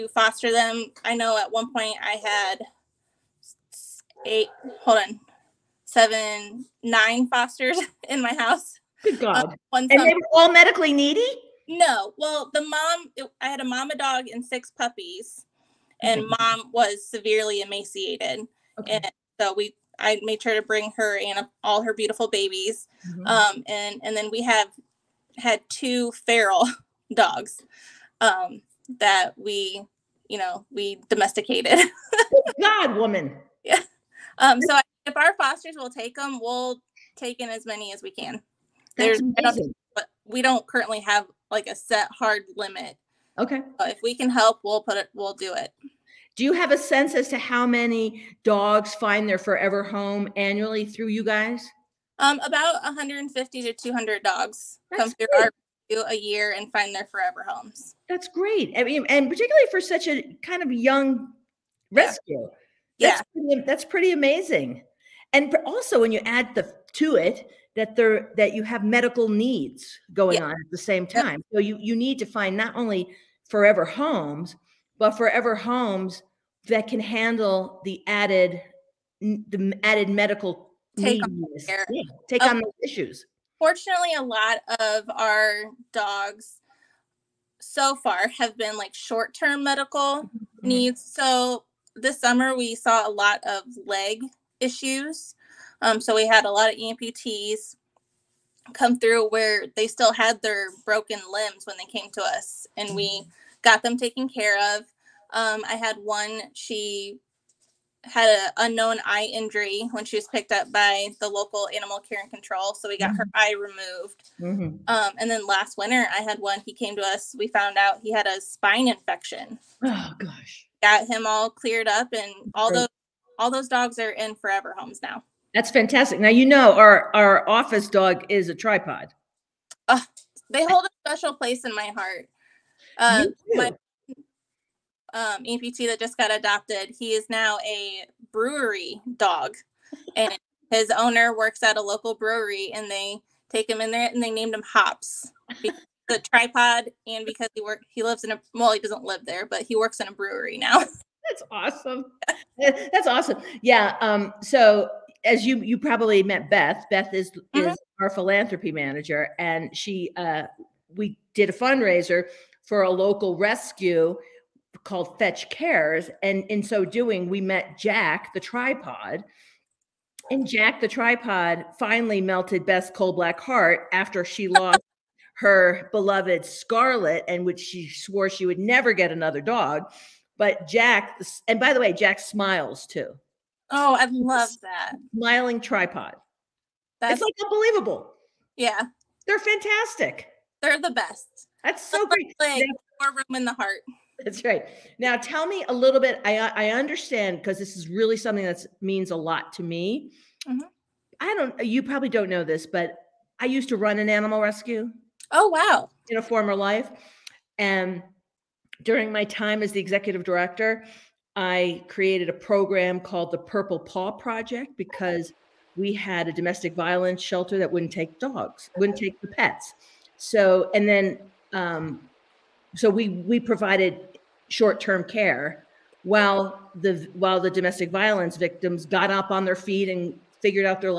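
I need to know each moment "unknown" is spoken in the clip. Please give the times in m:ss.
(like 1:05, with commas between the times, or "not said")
1:48.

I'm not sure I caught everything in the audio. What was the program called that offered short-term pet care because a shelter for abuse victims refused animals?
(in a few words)
Purple Paw Project.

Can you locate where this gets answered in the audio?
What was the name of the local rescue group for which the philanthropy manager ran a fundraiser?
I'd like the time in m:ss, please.
2:45.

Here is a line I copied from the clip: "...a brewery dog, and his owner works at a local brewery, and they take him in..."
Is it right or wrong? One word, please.
right.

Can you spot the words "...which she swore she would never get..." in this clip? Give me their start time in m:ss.
2:57.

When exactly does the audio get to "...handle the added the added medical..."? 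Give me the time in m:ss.
1:16.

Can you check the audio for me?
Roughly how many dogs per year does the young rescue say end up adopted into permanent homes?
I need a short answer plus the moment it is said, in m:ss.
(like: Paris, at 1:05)
150 to 200, at 0:52.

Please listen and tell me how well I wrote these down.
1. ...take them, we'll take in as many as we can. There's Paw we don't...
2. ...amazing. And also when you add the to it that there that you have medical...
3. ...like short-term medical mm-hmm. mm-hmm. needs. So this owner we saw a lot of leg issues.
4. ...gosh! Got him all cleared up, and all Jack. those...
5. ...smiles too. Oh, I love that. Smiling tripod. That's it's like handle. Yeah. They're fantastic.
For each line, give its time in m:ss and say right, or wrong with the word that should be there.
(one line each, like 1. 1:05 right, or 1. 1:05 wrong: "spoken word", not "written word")
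1. 0:35 wrong: "But", not "Paw"
2. 1:04 right
3. 1:28 wrong: "summer", not "owner"
4. 2:00 wrong: "Great", not "Jack"
5. 3:02 wrong: "unbelievable", not "handle".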